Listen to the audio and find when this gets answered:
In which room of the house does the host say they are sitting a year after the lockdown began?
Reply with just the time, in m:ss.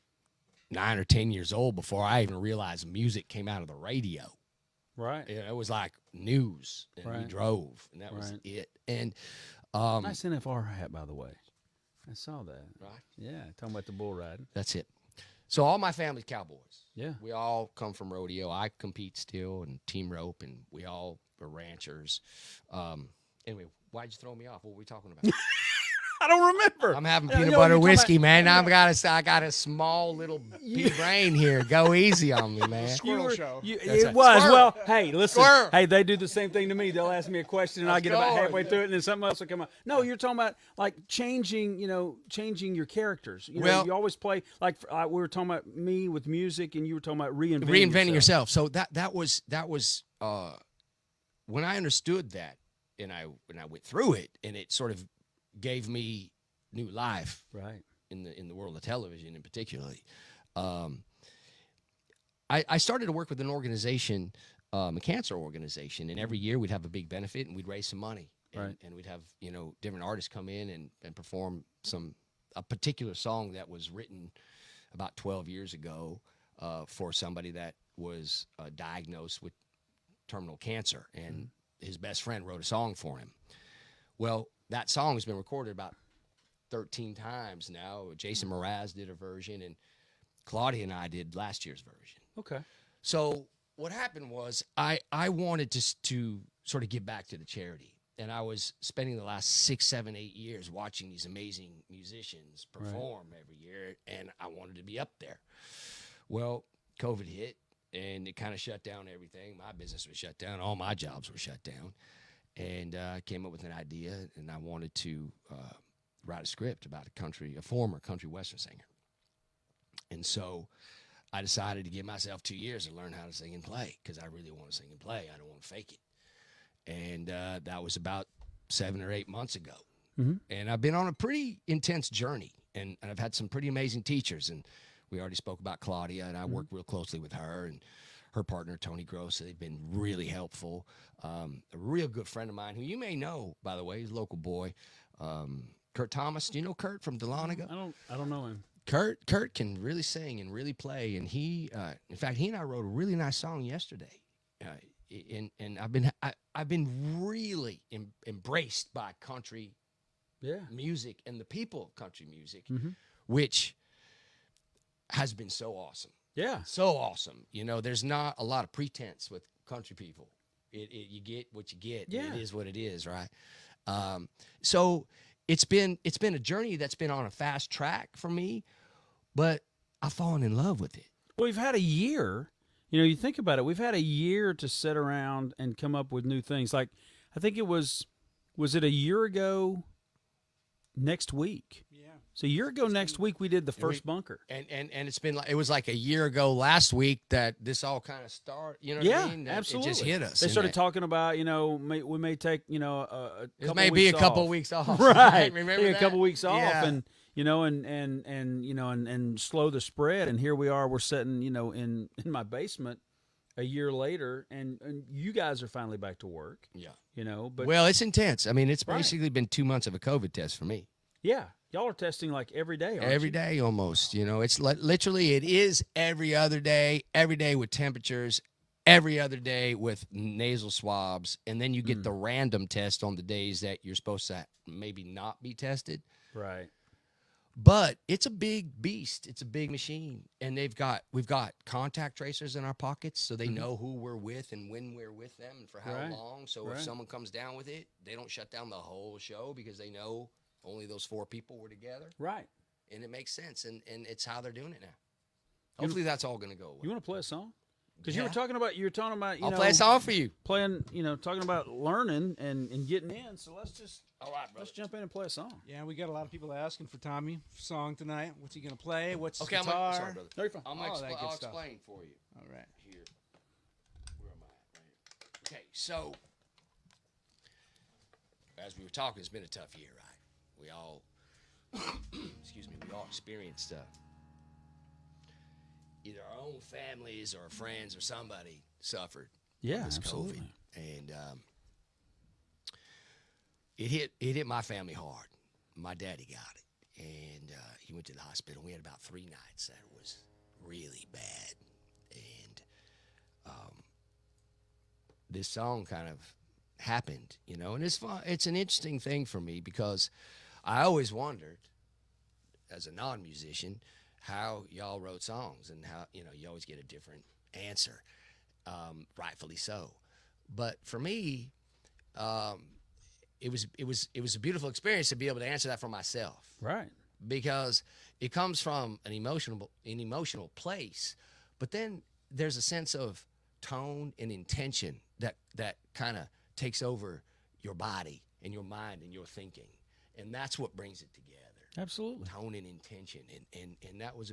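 3:32.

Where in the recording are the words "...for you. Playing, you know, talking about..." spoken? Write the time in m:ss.
4:20.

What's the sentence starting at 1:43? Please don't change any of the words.
every year, and I wanted to be up there.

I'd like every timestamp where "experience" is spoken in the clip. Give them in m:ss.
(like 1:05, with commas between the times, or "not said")
4:43, 5:24.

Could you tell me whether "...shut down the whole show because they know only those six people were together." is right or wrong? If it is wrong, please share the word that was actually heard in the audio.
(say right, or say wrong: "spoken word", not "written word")
wrong: "four", not "six".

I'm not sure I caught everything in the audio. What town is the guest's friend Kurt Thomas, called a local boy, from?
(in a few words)
Dahlonega.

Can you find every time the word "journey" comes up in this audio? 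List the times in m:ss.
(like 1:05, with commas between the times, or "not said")
2:12, 2:56.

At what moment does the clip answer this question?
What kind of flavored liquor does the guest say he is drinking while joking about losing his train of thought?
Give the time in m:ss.
0:27.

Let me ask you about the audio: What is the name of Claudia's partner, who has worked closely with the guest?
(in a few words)
Tony Gross.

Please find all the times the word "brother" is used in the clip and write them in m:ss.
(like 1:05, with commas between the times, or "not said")
4:24, 4:30.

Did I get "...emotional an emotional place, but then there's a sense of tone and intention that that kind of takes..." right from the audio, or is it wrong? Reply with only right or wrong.
right.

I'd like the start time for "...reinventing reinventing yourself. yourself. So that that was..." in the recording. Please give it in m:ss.
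0:47.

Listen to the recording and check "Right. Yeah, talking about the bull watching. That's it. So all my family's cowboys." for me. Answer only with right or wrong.
wrong.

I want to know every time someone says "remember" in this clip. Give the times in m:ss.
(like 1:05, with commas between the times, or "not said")
0:26, 3:25.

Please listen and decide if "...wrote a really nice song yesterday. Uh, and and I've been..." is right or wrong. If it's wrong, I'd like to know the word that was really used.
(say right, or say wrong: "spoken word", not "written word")
right.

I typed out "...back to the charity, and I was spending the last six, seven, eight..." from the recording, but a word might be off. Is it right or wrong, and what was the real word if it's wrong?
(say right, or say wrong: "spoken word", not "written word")
right.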